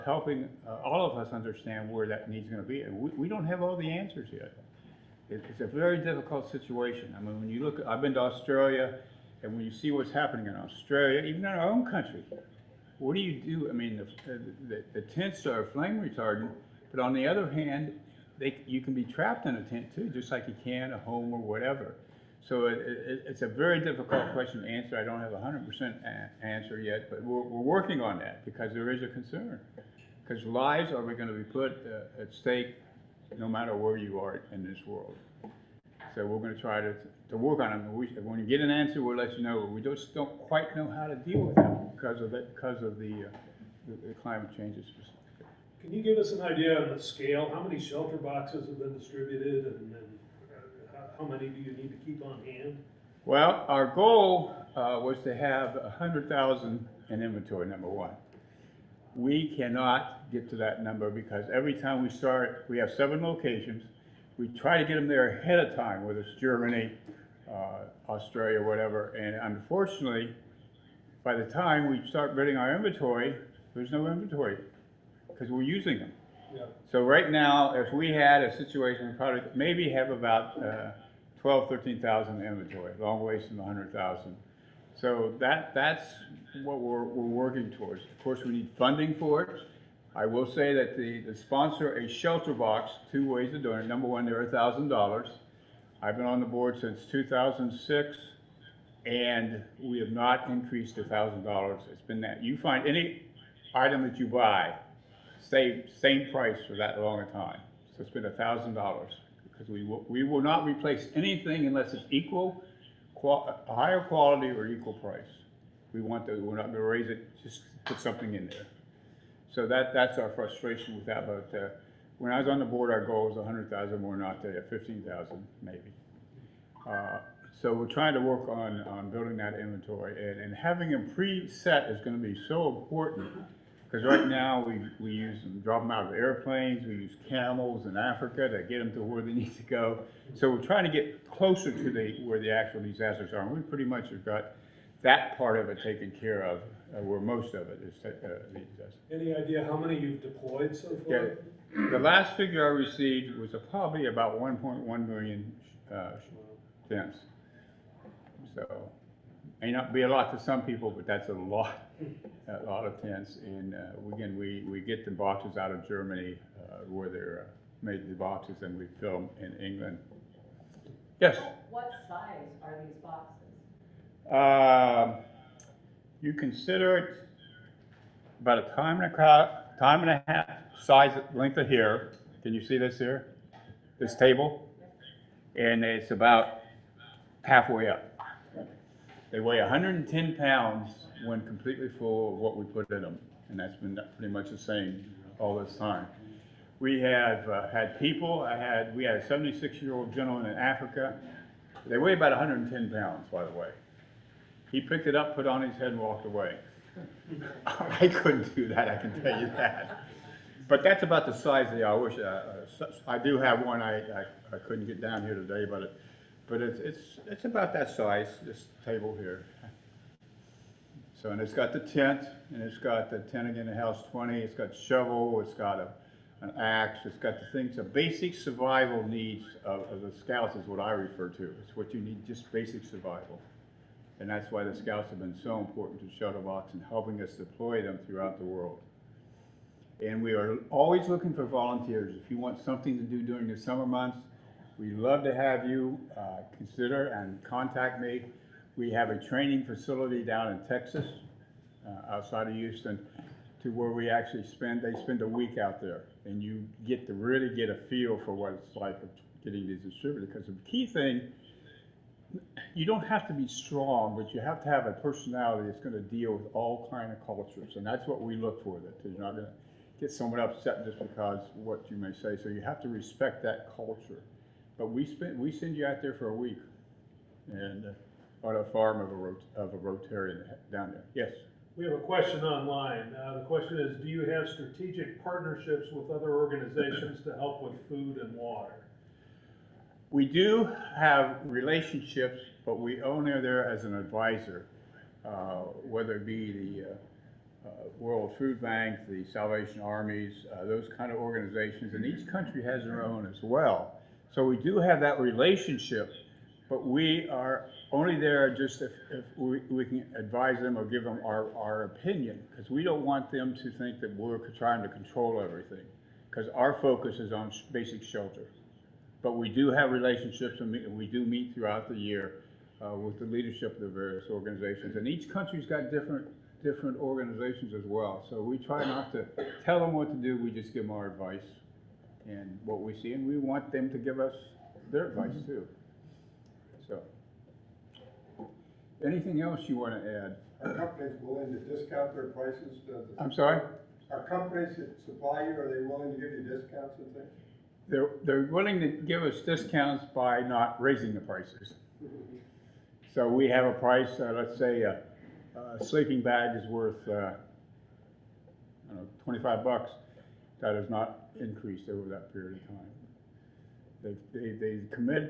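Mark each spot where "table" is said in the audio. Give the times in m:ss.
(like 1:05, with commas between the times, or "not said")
3:04, 3:38.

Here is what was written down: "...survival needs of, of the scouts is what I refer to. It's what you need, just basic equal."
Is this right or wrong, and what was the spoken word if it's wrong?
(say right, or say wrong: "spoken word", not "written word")
wrong: "survival", not "equal".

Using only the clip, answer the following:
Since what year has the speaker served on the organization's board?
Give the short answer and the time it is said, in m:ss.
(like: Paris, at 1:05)
2006, at 1:37.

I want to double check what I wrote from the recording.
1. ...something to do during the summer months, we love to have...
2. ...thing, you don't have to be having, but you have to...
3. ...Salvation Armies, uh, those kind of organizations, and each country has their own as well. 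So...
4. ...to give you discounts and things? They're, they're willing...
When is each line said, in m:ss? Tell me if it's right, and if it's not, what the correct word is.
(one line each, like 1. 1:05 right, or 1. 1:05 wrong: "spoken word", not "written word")
1. 4:02 right
2. 4:20 wrong: "strong", not "having"
3. 4:59 right
4. 5:46 right.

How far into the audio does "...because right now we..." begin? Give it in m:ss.
2:13.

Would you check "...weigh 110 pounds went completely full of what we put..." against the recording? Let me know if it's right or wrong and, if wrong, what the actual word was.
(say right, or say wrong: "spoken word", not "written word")
right.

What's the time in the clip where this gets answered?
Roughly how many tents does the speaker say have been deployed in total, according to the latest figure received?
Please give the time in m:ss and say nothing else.
2:34.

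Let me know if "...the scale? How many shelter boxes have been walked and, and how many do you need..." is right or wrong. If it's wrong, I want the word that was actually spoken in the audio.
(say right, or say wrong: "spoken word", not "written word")
wrong: "distributed", not "walked".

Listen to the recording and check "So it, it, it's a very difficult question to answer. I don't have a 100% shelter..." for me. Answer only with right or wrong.
wrong.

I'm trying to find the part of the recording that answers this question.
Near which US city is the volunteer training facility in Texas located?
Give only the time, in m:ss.
4:12.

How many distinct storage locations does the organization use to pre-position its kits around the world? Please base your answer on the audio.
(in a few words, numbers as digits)
7.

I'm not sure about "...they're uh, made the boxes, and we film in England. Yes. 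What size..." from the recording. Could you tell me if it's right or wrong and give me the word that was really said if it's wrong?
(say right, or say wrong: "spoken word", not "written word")
right.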